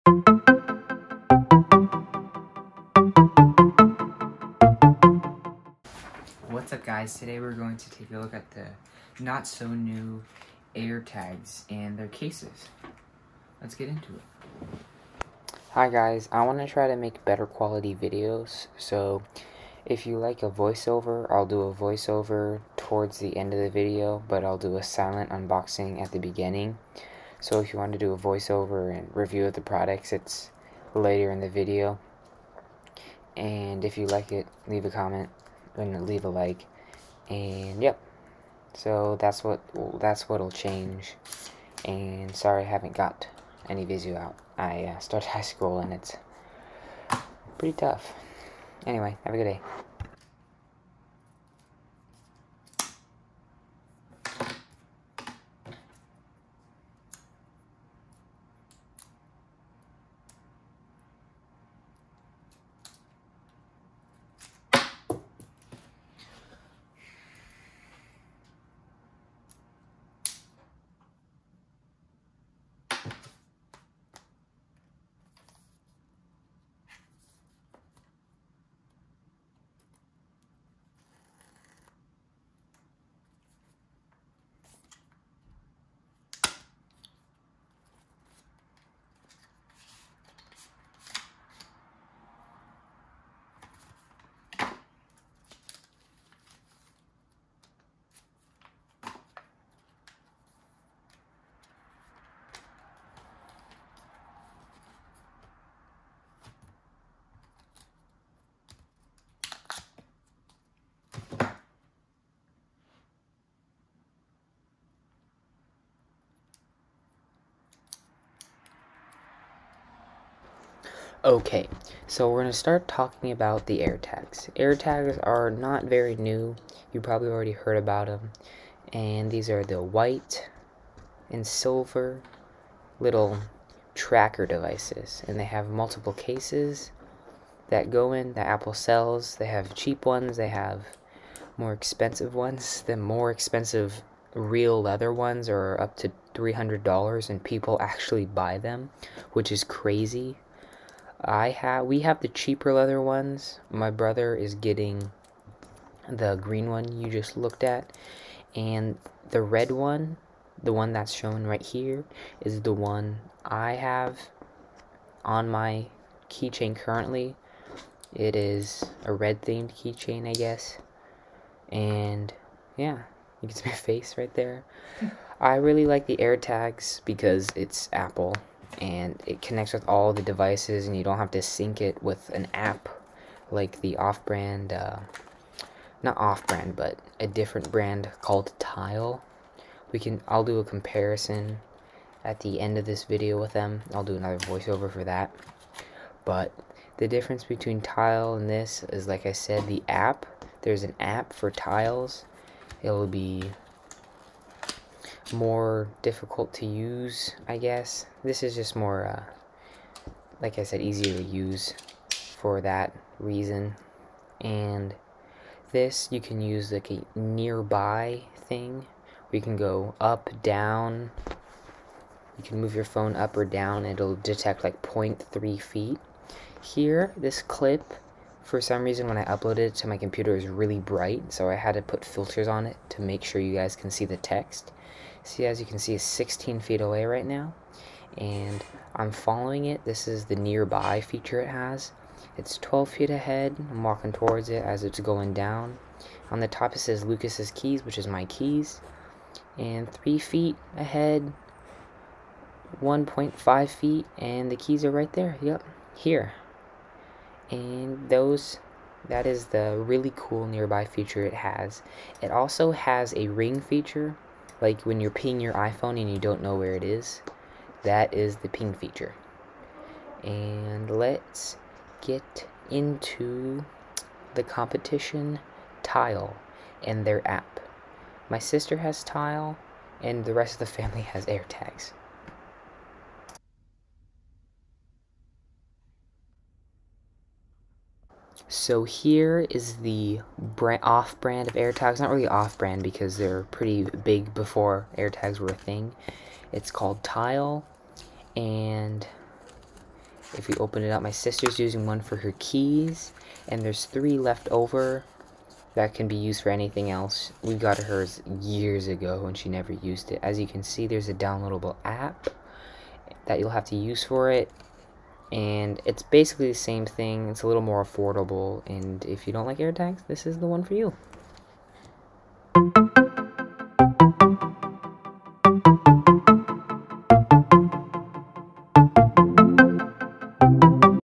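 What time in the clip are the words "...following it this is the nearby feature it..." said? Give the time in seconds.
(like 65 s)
239 s.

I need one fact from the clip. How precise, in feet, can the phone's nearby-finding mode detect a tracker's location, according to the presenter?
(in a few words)
0.3 feet.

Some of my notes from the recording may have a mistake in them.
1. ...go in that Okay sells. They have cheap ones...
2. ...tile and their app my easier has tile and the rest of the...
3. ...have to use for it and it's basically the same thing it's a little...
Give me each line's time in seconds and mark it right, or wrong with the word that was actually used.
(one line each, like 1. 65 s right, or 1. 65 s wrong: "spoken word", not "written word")
1. 137 s wrong: "Apple", not "Okay"
2. 275 s wrong: "sister", not "easier"
3. 313 s right.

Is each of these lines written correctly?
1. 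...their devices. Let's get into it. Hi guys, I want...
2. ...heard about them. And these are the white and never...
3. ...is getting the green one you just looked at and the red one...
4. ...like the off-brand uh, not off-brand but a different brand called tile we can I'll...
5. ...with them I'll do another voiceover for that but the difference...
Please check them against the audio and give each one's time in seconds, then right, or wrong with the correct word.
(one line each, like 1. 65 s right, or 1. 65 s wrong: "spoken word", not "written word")
1. 11 s wrong: "cases", not "devices"
2. 127 s wrong: "silver", not "never"
3. 154 s right
4. 183 s right
5. 193 s right.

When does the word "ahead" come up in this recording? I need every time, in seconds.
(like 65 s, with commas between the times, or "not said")
243 s, 250 s.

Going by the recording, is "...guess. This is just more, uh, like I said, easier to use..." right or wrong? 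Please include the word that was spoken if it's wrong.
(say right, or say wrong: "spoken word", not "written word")
right.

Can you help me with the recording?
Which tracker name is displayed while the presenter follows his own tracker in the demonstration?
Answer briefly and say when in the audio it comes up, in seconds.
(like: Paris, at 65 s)
Lucas's keys, at 247 s.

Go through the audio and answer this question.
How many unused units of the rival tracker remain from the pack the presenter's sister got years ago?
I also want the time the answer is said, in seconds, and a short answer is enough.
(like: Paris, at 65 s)
3, at 303 s.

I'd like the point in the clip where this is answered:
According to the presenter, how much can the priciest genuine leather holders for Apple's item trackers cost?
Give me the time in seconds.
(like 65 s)
146 s.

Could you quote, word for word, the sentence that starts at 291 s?
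Not really off-brand because they're pretty big before AirTags were a thing.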